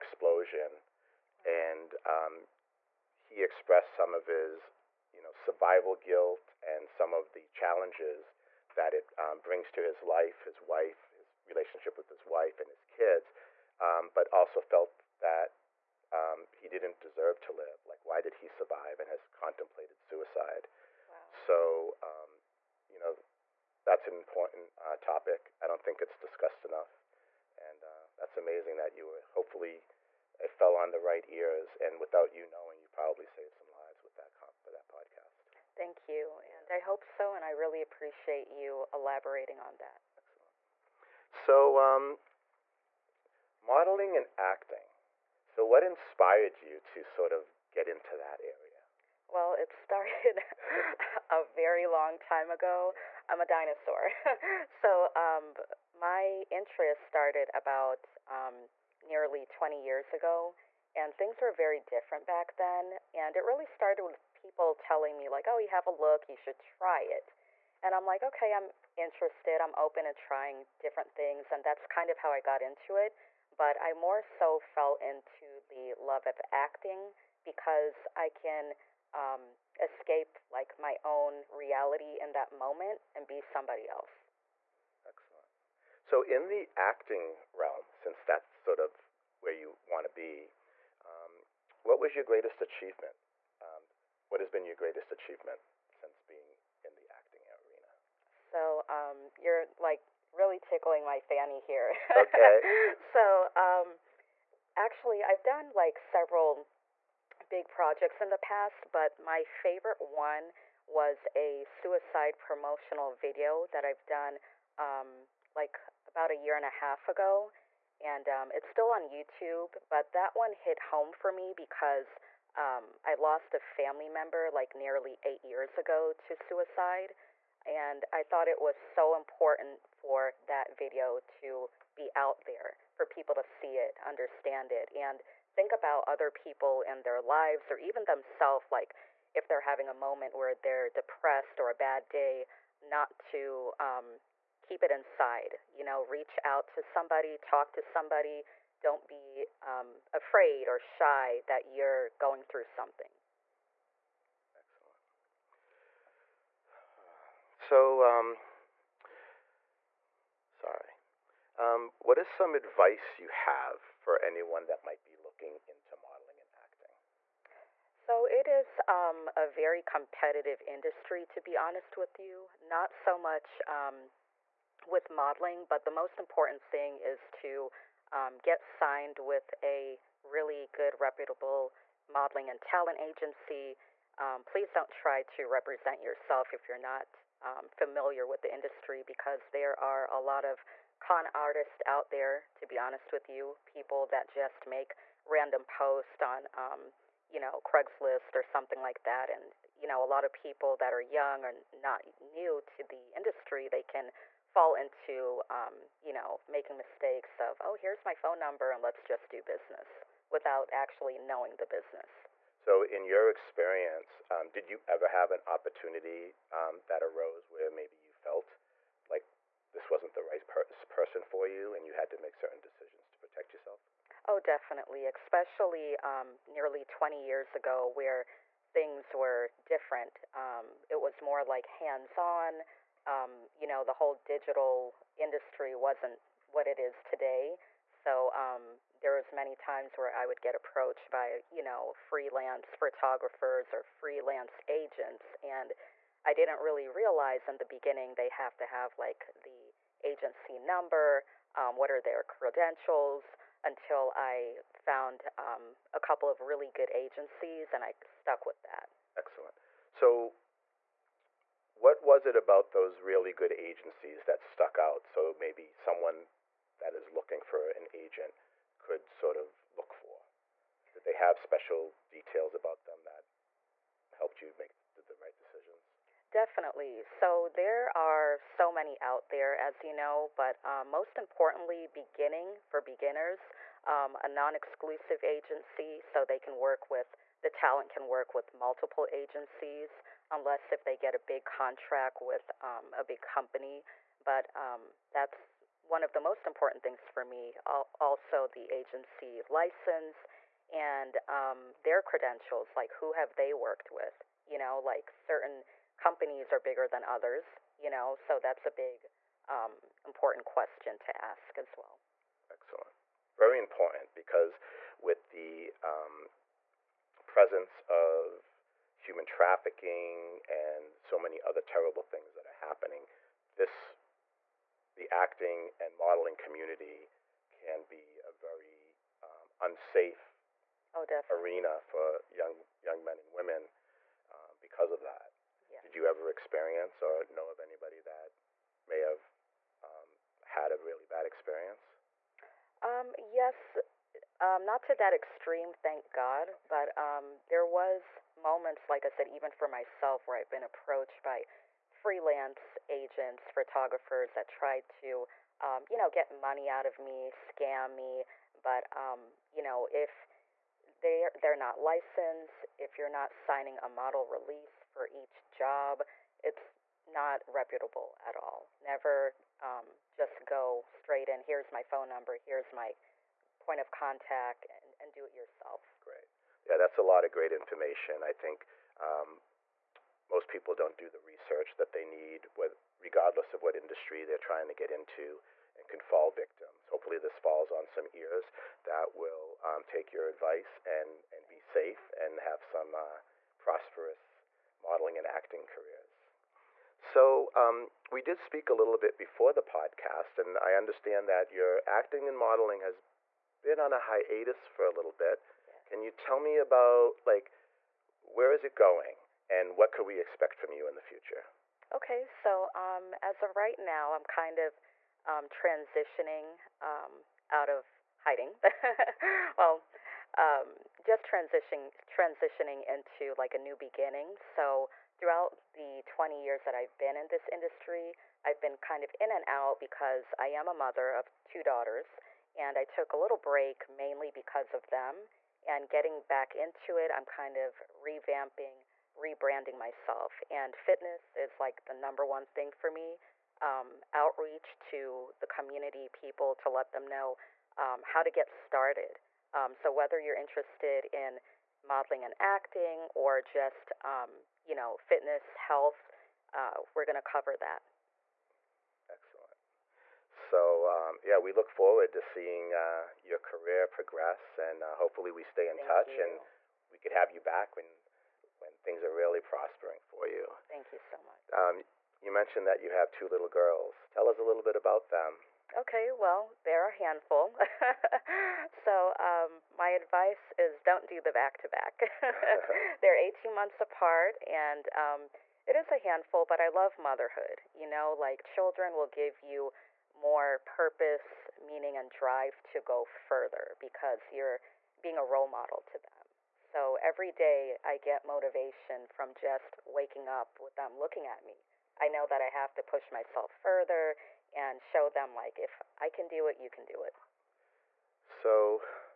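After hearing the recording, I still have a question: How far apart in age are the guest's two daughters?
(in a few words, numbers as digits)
18 months.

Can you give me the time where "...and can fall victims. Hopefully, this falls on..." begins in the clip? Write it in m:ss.
6:25.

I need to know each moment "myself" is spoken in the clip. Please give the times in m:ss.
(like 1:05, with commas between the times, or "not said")
5:49, 7:19, 8:23.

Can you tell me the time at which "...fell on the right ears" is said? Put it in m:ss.
0:30.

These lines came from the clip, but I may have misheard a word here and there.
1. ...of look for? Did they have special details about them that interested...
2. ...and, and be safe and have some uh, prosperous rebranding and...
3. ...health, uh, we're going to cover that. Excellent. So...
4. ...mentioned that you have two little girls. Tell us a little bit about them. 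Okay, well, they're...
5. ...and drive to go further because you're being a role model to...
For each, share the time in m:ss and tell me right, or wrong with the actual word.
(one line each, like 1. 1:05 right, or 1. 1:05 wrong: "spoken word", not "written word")
1. 4:29 wrong: "helped", not "interested"
2. 6:30 wrong: "modeling", not "rebranding"
3. 7:35 right
4. 7:52 right
5. 8:11 right.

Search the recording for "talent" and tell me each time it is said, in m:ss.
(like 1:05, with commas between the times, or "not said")
3:02, 4:47.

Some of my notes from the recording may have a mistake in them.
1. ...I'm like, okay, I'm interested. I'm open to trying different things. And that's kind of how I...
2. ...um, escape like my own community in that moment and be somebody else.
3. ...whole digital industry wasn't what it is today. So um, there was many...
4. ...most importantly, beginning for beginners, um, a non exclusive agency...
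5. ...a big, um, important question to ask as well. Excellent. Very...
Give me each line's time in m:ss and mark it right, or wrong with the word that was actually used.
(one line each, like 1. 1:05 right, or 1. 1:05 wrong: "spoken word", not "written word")
1. 1:07 right
2. 1:19 wrong: "reality", not "community"
3. 3:53 right
4. 4:40 right
5. 5:08 right.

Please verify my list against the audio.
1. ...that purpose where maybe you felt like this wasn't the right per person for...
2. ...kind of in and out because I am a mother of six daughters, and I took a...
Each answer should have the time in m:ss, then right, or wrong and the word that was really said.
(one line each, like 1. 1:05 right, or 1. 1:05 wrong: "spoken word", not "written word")
1. 3:36 wrong: "arose", not "purpose"
2. 7:08 wrong: "two", not "six".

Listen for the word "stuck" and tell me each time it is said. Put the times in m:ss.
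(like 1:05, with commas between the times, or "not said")
4:18, 4:24.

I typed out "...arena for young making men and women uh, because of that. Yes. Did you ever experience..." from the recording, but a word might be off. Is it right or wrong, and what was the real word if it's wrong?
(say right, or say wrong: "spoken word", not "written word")
wrong: "young", not "making".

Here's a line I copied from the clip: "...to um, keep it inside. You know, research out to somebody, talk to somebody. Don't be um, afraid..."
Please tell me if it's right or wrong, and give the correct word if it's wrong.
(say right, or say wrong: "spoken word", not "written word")
wrong: "reach", not "research".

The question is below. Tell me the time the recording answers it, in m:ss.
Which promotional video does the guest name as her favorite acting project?
1:51.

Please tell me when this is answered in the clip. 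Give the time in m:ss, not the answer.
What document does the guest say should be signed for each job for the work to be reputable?
6:03.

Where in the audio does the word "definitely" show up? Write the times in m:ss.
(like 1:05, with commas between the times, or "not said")
3:44, 4:36.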